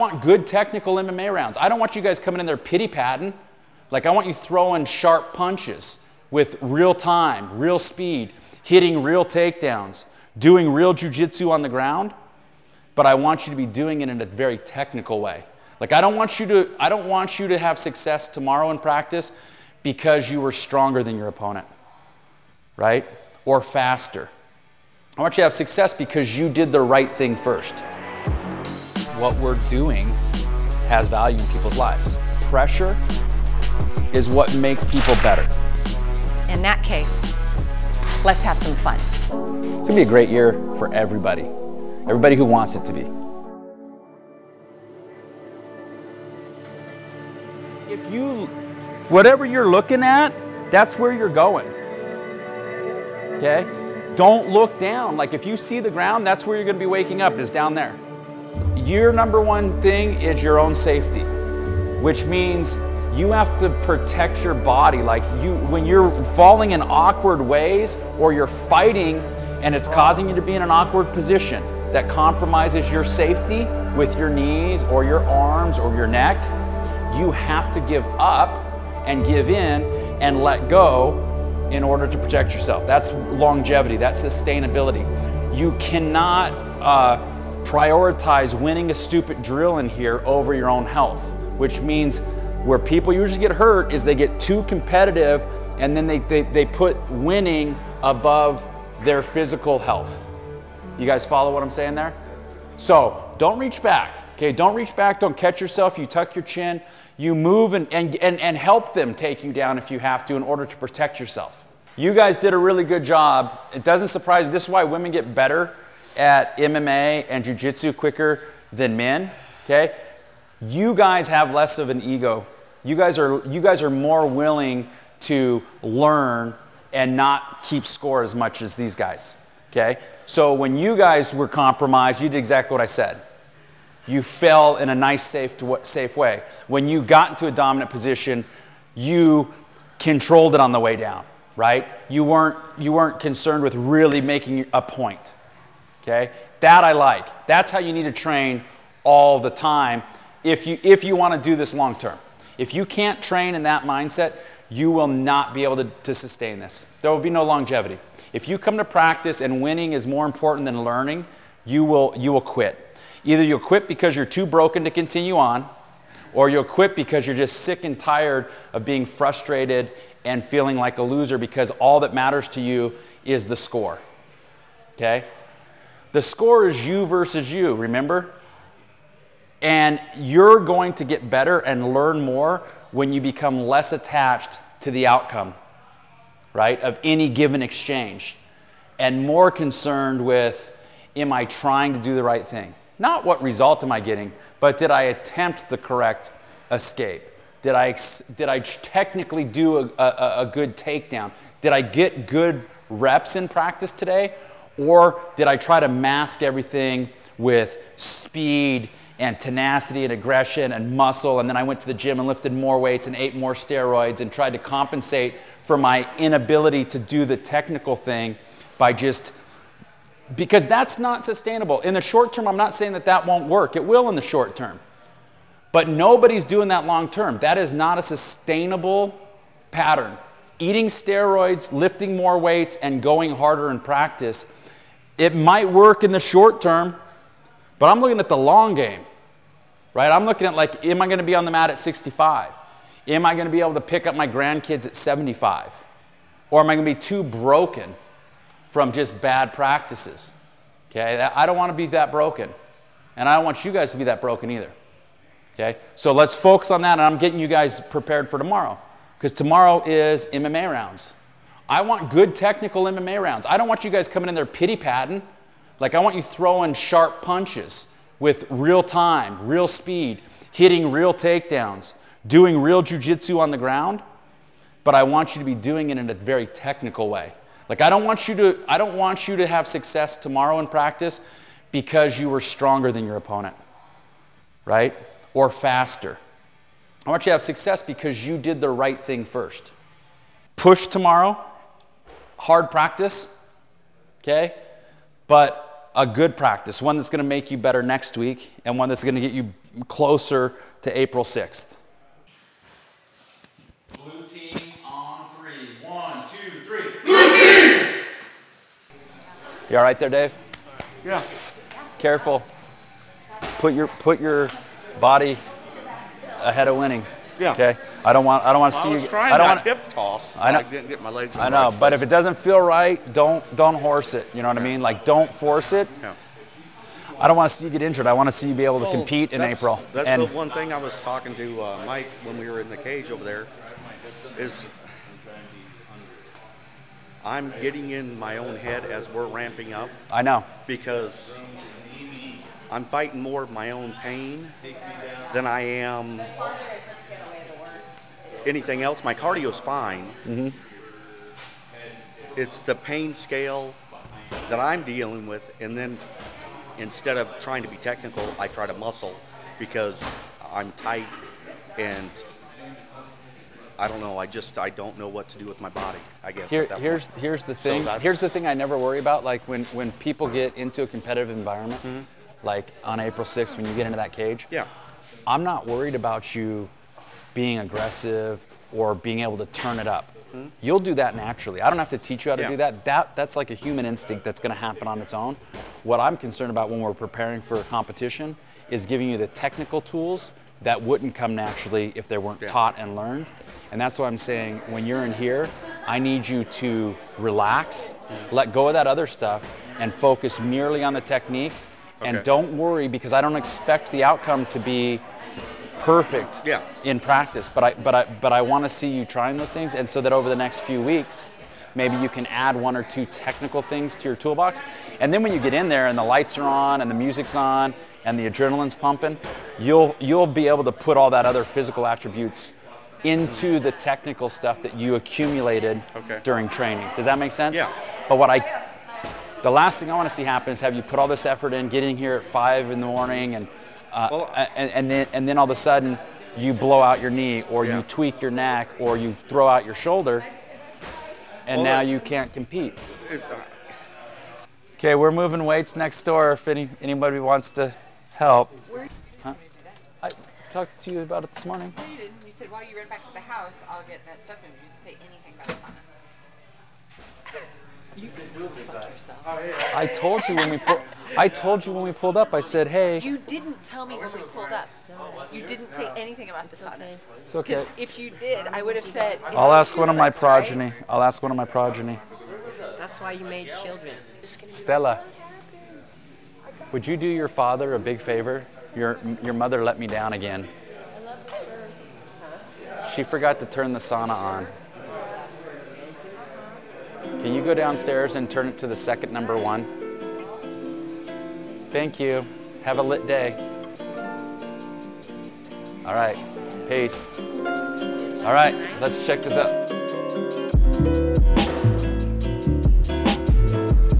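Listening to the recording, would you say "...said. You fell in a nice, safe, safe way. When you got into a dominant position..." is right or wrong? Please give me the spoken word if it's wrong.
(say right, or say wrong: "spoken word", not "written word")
right.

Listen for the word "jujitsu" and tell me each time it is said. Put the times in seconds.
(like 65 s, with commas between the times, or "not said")
10 s, 272 s.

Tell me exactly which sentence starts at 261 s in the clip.
I want good technical MMA rounds.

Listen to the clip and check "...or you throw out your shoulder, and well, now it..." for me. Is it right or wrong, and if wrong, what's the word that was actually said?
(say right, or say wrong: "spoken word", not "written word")
right.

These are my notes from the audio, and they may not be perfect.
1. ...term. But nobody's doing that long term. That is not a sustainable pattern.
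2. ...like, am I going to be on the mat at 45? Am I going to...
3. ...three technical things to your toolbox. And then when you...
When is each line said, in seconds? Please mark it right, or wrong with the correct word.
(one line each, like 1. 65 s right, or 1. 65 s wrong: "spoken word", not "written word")
1. 224 s right
2. 240 s wrong: "65", not "45"
3. 412 s wrong: "two", not "three".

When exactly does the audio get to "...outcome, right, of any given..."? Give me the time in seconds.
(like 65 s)
185 s.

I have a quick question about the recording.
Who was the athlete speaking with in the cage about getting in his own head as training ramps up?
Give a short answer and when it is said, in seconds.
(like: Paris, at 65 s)
Mike, at 331 s.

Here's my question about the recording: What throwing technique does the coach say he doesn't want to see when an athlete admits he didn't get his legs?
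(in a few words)
Hip toss.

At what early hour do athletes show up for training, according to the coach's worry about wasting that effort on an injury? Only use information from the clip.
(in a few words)
5 in the morning.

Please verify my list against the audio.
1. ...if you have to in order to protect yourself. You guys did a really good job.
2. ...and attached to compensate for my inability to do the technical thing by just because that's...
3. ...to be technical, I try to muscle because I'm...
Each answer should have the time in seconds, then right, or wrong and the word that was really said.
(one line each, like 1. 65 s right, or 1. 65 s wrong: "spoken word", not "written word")
1. 109 s right
2. 214 s wrong: "tried", not "attached"
3. 357 s right.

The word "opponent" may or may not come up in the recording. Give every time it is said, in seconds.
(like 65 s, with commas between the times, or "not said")
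21 s, 283 s.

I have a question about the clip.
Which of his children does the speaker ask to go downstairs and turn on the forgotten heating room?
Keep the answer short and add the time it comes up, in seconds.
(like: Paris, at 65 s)
Stella, at 474 s.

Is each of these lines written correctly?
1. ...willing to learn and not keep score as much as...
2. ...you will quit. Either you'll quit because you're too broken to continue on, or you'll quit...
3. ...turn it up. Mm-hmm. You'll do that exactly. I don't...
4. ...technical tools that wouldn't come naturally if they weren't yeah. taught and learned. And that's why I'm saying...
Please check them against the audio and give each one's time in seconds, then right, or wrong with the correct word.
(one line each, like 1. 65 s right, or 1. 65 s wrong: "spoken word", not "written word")
1. 124 s right
2. 162 s right
3. 379 s wrong: "naturally", not "exactly"
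4. 389 s right.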